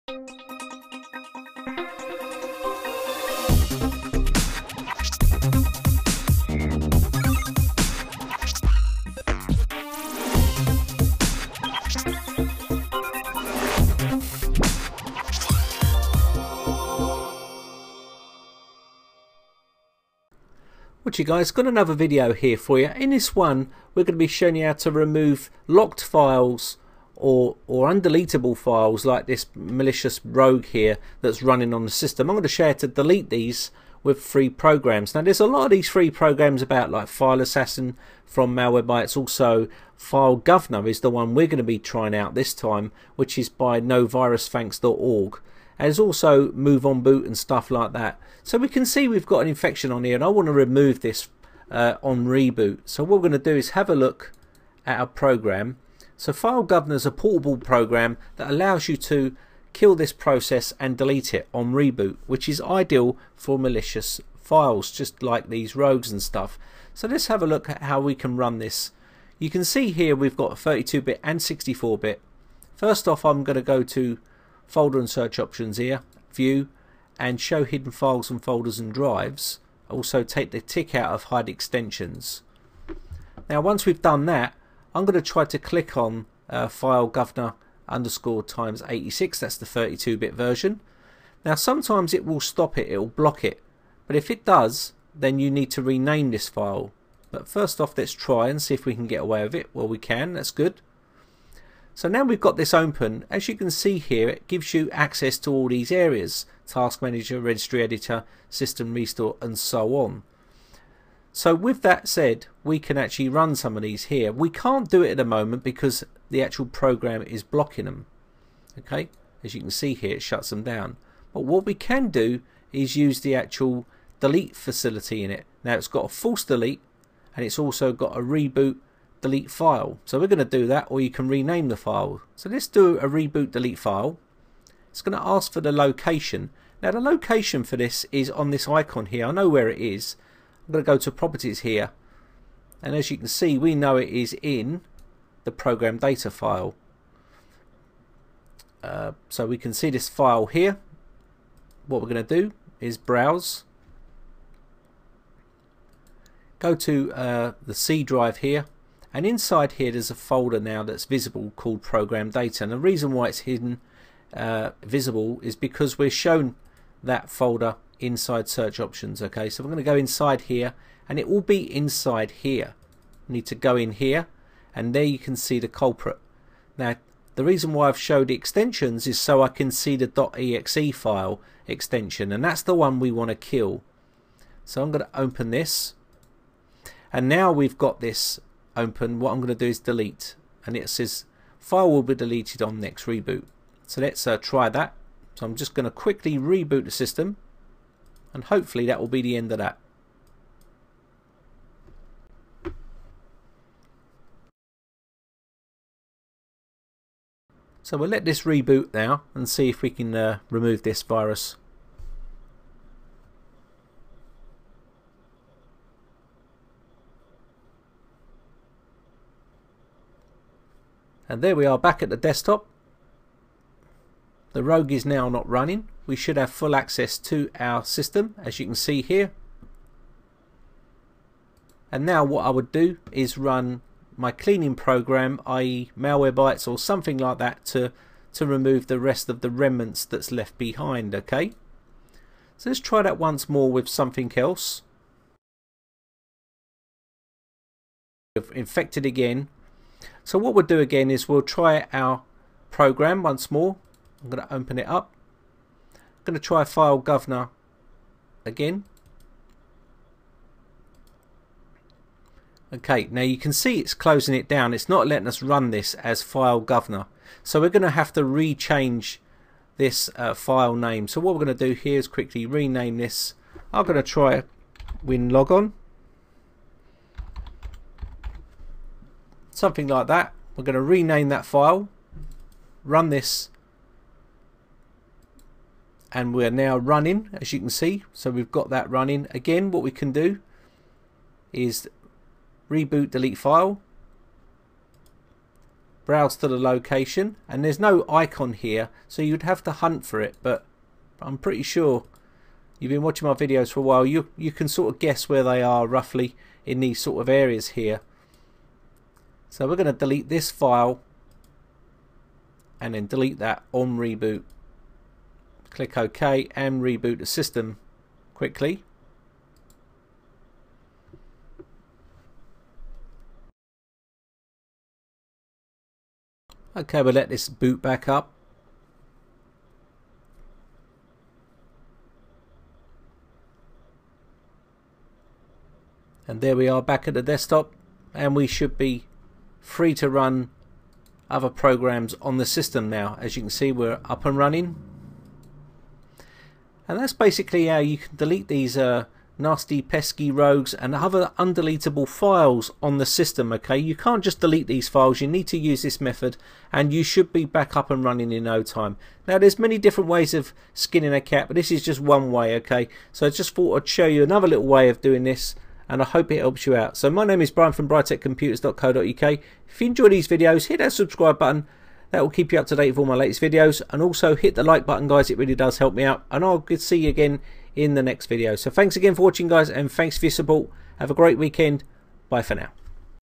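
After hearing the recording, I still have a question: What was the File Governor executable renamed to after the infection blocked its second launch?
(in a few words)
Win Logon.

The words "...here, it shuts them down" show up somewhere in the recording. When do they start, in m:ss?
1:59.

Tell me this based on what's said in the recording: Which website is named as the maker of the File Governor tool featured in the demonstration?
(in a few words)
novirusthanks.org.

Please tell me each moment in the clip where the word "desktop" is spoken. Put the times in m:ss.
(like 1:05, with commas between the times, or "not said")
3:42, 5:37.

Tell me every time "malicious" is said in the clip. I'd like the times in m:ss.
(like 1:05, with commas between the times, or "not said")
0:29, 1:03.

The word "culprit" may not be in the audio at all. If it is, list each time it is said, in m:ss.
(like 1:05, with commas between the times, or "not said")
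2:55.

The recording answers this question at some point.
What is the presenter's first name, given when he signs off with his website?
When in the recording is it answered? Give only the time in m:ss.
6:07.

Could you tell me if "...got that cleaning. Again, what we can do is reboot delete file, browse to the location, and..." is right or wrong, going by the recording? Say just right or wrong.
wrong.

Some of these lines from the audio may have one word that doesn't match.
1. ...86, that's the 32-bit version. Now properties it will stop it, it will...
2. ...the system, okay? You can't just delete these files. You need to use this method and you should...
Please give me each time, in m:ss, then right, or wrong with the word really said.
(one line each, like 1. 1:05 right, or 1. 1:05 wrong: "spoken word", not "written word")
1. 1:28 wrong: "sometimes", not "properties"
2. 5:52 right.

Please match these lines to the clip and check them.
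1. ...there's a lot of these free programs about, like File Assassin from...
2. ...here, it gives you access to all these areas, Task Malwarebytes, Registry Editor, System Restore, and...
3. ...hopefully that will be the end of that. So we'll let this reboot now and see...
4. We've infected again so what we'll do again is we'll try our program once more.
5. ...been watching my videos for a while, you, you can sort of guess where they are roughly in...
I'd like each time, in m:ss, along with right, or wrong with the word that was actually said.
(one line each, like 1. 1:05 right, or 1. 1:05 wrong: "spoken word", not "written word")
1. 0:35 right
2. 1:43 wrong: "Manager", not "Malwarebytes"
3. 3:18 right
4. 4:08 right
5. 5:02 right.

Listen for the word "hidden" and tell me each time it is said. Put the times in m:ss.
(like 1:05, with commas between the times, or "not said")
1:17, 2:43.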